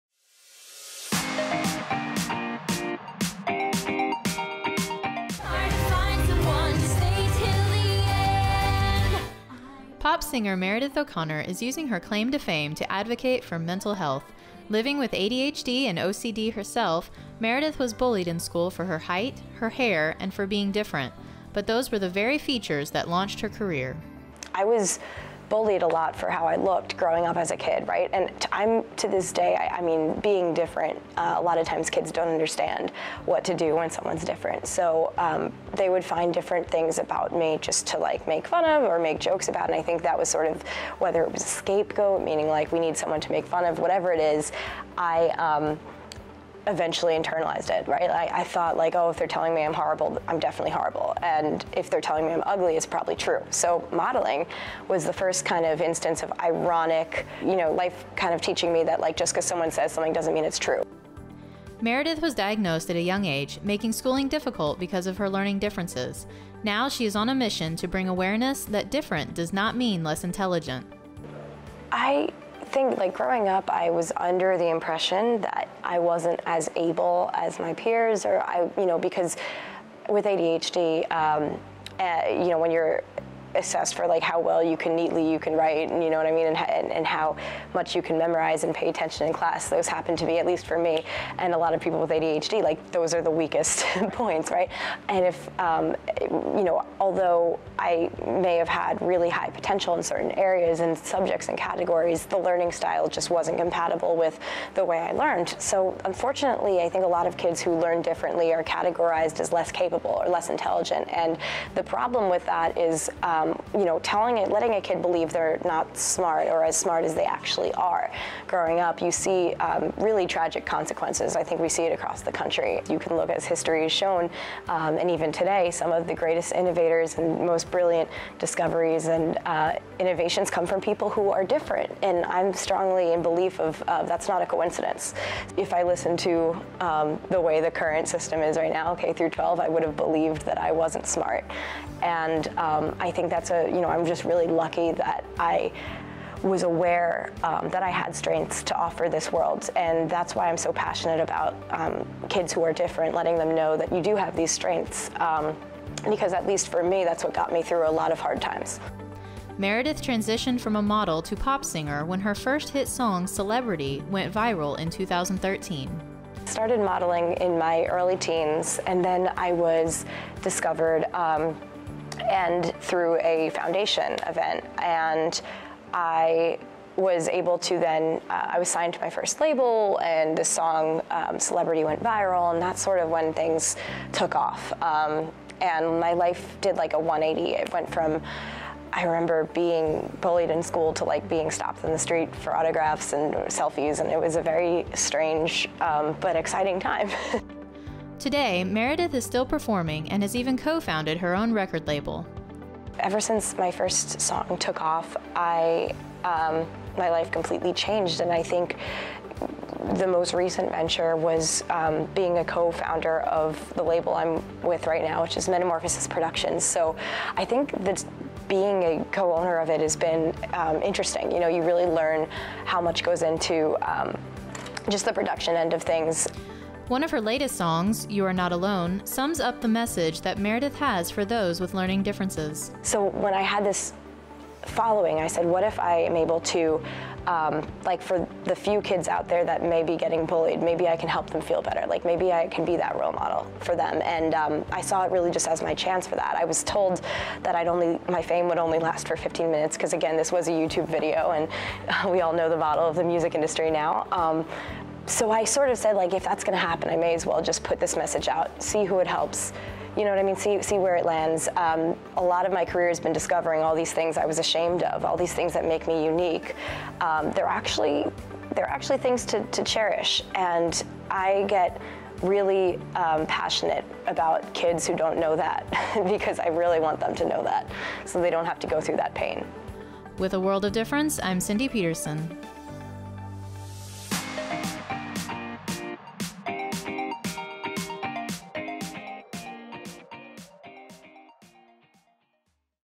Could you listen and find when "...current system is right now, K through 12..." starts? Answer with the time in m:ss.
2:17.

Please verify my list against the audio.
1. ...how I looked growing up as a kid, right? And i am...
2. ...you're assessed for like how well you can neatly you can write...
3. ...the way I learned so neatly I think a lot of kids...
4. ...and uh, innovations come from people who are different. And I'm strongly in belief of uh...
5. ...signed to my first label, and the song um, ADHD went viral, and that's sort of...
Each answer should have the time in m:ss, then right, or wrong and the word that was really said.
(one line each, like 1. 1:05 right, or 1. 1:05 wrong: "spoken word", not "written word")
1. 0:26 right
2. 1:22 right
3. 1:44 wrong: "unfortunately", not "neatly"
4. 2:09 right
5. 2:58 wrong: "Celebrity", not "ADHD".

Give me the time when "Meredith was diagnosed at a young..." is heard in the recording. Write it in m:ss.
1:01.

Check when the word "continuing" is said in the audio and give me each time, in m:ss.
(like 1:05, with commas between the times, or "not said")
not said.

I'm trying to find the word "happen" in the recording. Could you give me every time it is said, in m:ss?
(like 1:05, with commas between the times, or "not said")
1:29, 4:16.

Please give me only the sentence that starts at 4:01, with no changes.
Like maybe I can be that role model for them.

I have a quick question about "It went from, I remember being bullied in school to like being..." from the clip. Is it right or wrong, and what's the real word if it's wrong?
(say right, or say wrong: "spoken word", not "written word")
right.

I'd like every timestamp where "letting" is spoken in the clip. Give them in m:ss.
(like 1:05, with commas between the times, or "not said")
1:54, 2:33.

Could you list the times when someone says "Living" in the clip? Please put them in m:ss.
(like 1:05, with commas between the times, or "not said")
0:14.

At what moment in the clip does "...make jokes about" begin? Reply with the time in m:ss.
0:38.